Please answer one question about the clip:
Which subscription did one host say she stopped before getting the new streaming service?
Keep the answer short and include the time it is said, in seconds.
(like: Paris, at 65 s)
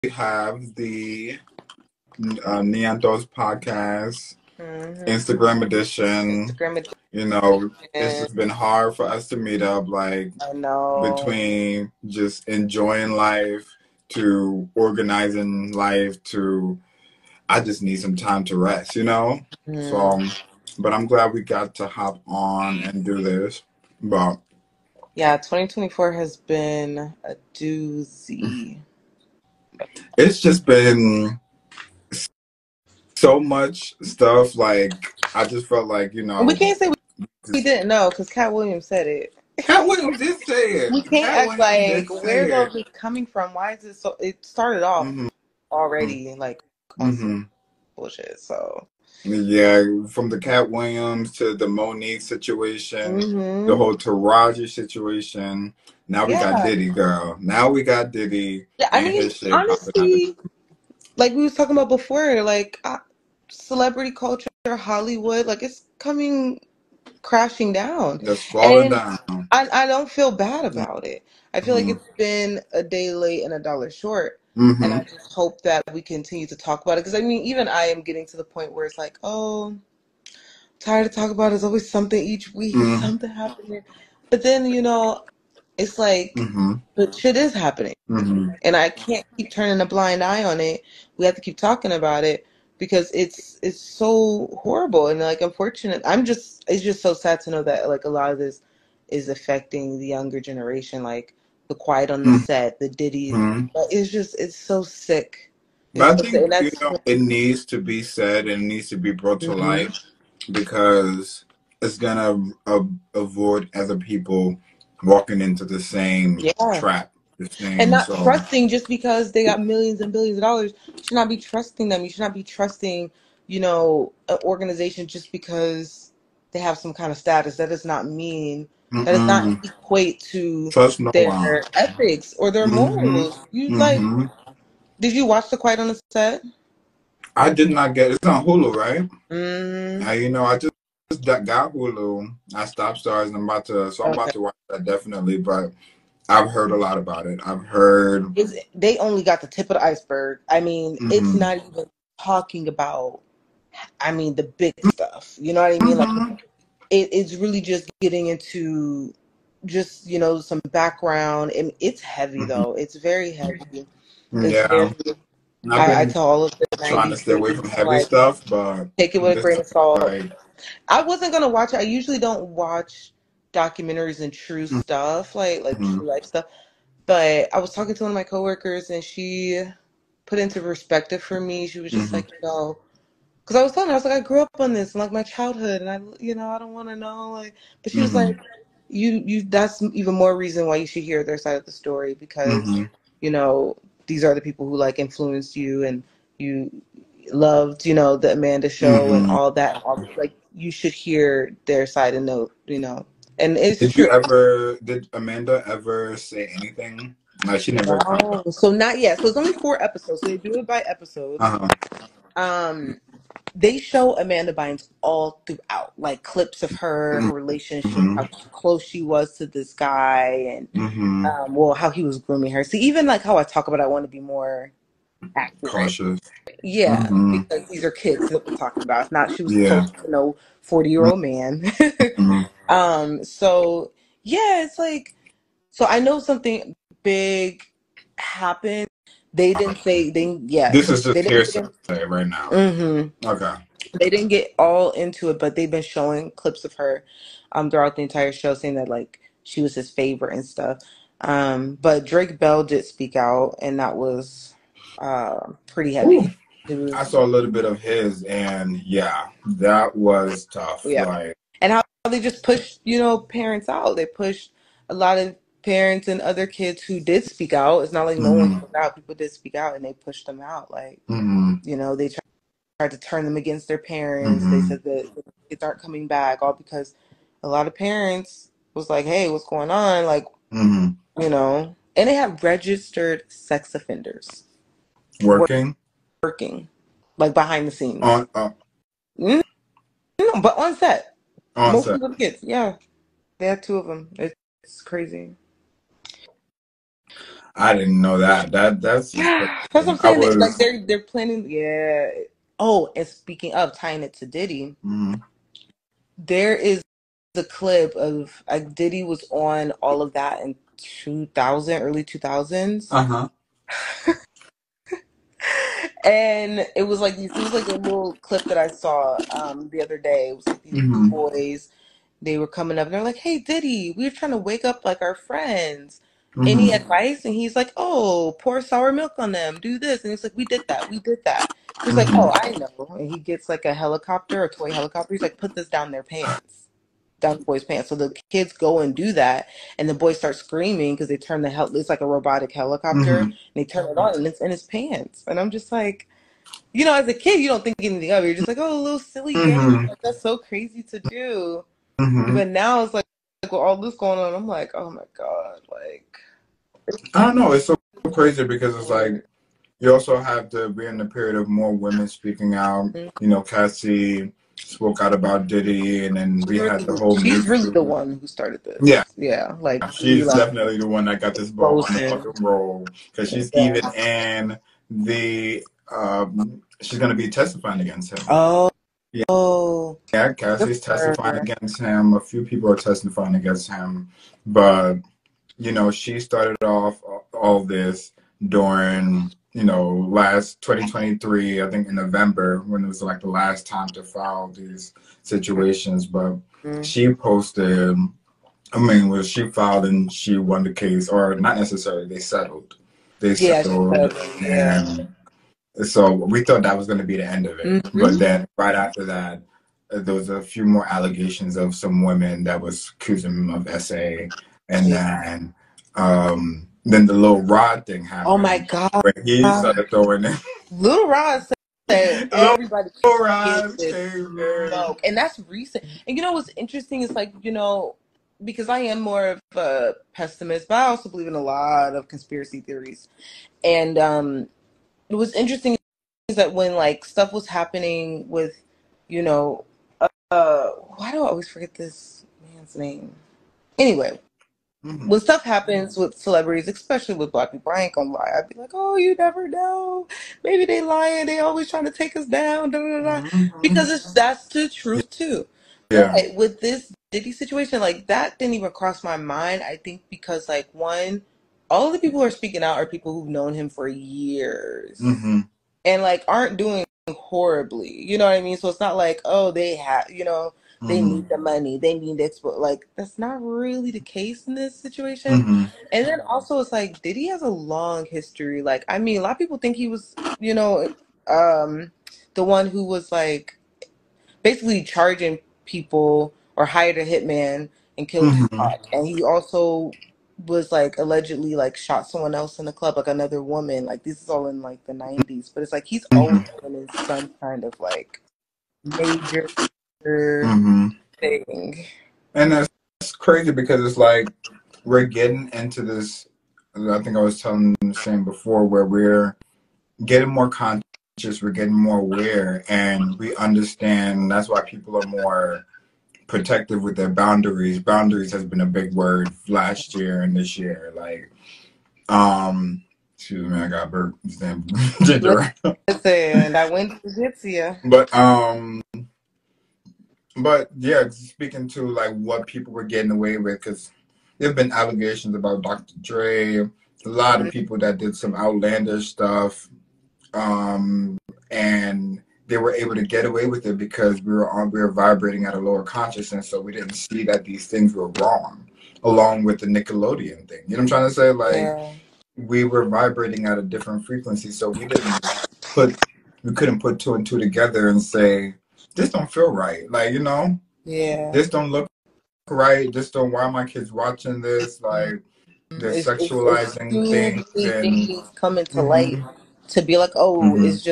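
Starz, at 142 s.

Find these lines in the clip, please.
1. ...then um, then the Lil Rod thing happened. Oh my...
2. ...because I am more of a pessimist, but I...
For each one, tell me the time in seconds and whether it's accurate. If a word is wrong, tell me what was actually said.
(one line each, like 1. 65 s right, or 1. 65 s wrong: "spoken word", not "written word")
1. 415 s right
2. 428 s right.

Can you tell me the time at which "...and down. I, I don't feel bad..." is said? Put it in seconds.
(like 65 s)
68 s.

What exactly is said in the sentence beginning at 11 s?
Between just enjoying life to organizing life to, I just need some time to rest, you know?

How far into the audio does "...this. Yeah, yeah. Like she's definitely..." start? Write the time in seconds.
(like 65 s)
368 s.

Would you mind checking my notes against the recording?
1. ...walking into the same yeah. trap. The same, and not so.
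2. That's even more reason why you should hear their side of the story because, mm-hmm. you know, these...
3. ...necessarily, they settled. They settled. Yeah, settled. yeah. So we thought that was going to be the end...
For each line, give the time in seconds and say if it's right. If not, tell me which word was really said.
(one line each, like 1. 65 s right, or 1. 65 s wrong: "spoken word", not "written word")
1. 115 s right
2. 189 s right
3. 401 s right.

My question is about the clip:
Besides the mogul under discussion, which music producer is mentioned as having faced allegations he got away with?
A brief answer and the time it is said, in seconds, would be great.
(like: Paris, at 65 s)
Dr. Dre, at 535 s.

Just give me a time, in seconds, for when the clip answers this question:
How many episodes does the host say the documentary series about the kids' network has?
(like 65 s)
209 s.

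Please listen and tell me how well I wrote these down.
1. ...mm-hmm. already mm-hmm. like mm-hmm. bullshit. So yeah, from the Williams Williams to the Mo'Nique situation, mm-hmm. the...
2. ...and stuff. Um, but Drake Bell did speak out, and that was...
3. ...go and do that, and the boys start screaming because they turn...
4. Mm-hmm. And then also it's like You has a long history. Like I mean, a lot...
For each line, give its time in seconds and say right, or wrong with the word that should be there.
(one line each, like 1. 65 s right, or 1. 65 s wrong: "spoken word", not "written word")
1. 45 s wrong: "Katt", not "Williams"
2. 250 s right
3. 338 s right
4. 475 s wrong: "Diddy", not "You".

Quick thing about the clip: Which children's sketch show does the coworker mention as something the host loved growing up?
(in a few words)
The Amanda Show.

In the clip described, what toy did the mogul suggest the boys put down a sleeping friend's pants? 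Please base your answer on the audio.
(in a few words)
toy helicopter.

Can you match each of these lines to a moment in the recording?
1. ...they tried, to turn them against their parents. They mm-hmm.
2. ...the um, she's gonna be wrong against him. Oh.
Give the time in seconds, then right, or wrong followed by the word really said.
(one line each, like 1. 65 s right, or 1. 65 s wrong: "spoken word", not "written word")
1. 271 s right
2. 374 s wrong: "testifying", not "wrong".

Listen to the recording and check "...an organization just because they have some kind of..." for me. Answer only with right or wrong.
right.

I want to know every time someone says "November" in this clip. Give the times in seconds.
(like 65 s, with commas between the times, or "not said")
391 s.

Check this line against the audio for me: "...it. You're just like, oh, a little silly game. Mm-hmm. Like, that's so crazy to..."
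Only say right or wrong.
right.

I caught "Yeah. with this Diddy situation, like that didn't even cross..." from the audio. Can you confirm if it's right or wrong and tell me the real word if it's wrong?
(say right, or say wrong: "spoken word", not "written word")
right.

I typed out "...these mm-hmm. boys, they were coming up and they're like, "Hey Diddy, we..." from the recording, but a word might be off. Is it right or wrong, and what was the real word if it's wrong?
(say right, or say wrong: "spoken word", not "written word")
right.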